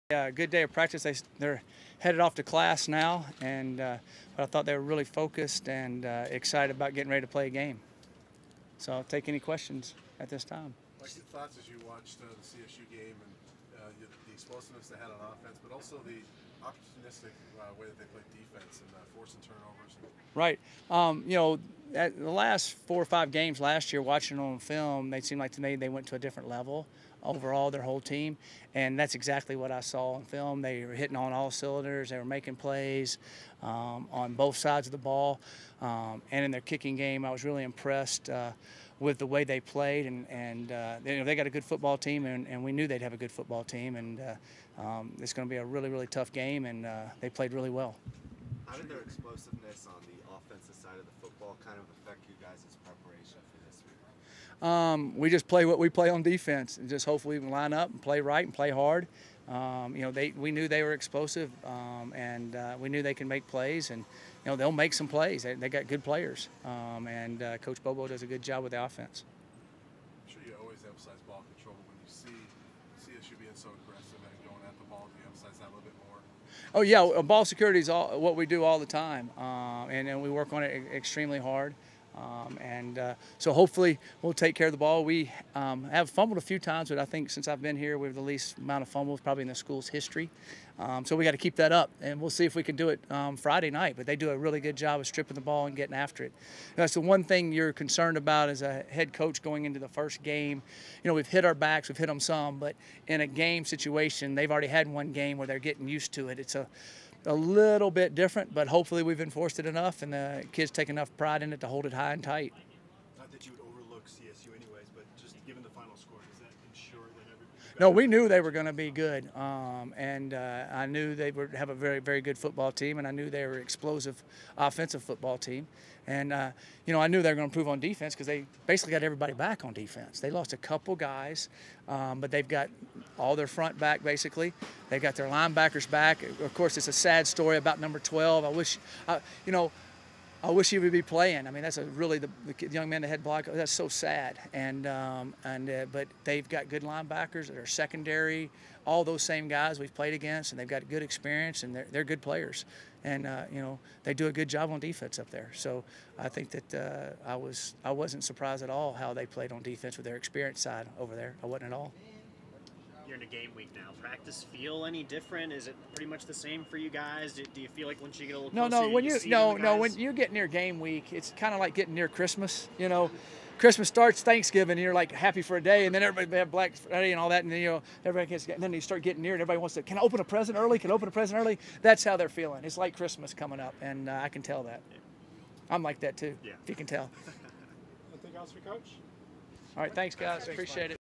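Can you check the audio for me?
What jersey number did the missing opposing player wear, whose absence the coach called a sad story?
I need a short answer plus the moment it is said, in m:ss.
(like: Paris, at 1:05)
12, at 2:17.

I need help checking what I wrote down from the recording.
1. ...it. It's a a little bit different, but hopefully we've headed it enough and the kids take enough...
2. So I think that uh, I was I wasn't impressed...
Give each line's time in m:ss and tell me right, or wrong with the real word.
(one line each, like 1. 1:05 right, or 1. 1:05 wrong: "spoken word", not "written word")
1. 1:46 wrong: "enforced", not "headed"
2. 2:35 wrong: "surprised", not "impressed".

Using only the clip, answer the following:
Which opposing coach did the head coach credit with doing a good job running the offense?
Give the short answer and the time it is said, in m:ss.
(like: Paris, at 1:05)
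Coach Bobo, at 1:07.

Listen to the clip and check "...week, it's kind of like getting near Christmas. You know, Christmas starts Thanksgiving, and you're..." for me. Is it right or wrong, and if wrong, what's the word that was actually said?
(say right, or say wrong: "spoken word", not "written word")
right.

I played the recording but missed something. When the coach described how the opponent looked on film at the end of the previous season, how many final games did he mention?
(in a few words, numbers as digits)
4 or 5.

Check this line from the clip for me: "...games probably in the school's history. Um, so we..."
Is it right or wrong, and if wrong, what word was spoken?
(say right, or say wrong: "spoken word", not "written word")
wrong: "fumbles", not "games".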